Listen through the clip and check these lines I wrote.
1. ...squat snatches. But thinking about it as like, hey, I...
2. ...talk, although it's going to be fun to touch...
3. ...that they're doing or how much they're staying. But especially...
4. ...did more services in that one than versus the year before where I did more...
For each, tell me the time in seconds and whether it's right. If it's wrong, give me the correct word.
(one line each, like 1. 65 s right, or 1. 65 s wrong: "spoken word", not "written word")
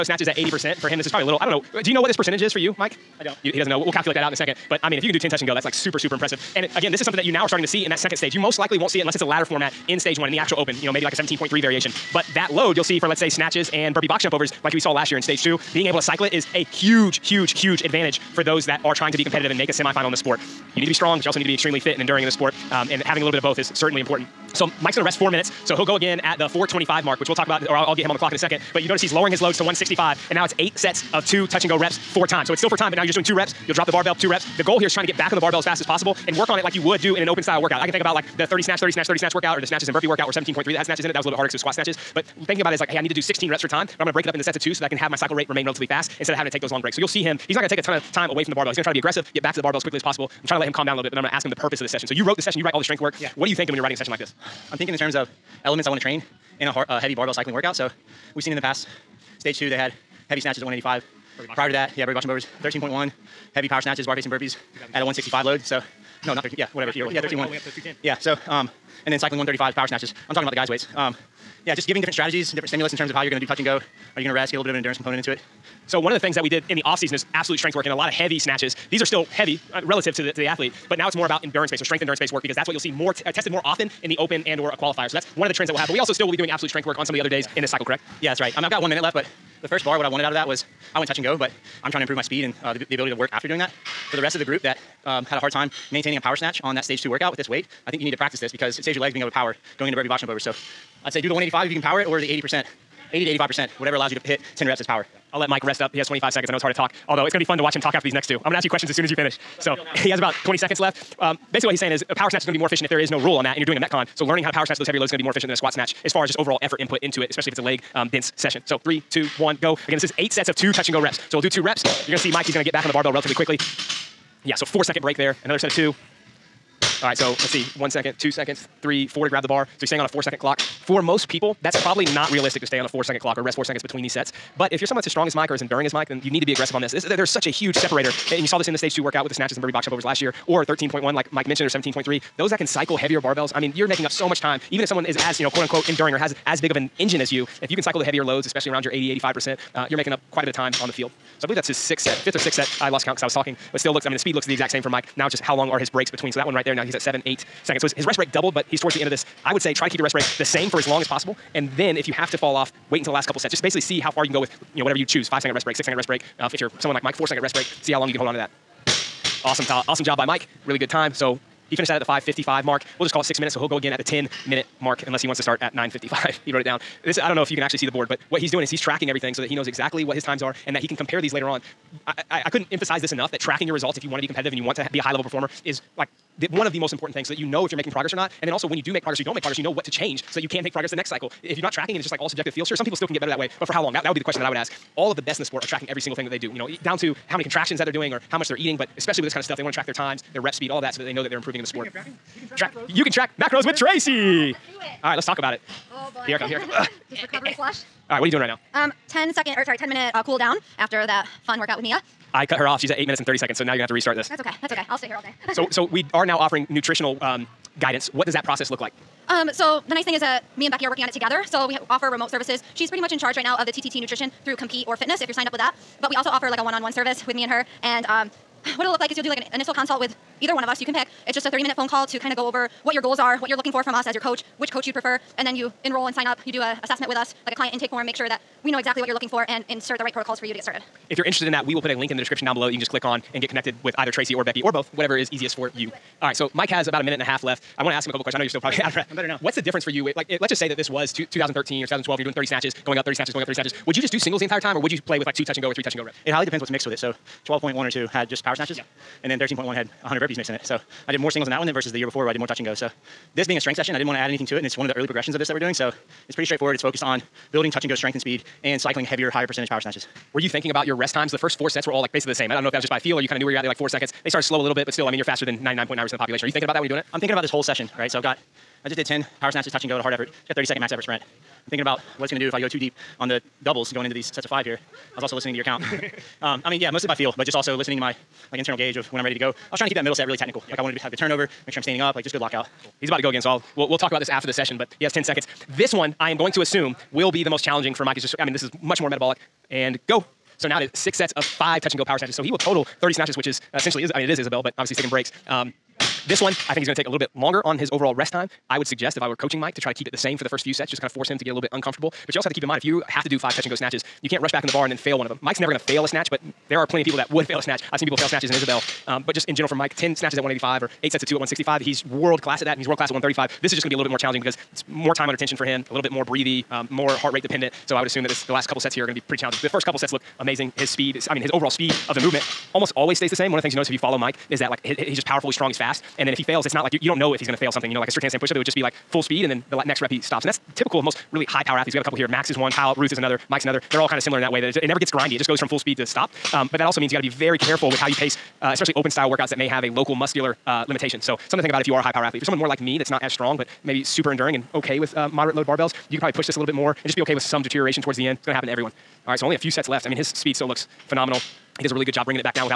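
1. 41 s right
2. 106 s wrong: "watch", not "touch"
3. 197 s wrong: "eating", not "staying"
4. 261 s wrong: "singles", not "services".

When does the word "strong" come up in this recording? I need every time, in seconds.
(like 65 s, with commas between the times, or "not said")
20 s, 135 s, 335 s, 353 s.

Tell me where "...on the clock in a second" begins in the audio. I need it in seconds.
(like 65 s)
28 s.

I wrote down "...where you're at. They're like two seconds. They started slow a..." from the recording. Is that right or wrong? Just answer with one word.
wrong.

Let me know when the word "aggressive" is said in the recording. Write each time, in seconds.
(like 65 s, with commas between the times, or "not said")
48 s, 136 s.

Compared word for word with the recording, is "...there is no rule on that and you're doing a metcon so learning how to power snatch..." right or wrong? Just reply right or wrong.
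right.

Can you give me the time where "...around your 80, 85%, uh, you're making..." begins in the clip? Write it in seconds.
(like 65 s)
148 s.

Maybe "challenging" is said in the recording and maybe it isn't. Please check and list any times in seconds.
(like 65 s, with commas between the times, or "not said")
297 s, 324 s, 329 s.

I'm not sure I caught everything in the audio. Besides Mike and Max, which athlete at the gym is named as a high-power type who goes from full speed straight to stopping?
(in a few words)
Kyle Ruth.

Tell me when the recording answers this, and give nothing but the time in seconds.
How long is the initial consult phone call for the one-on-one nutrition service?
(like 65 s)
231 s.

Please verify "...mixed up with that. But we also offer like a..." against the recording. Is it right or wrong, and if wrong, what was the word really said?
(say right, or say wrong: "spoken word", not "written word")
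wrong: "signed", not "mixed".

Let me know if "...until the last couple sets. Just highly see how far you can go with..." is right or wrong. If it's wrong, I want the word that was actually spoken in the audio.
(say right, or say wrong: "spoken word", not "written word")
wrong: "basically", not "highly".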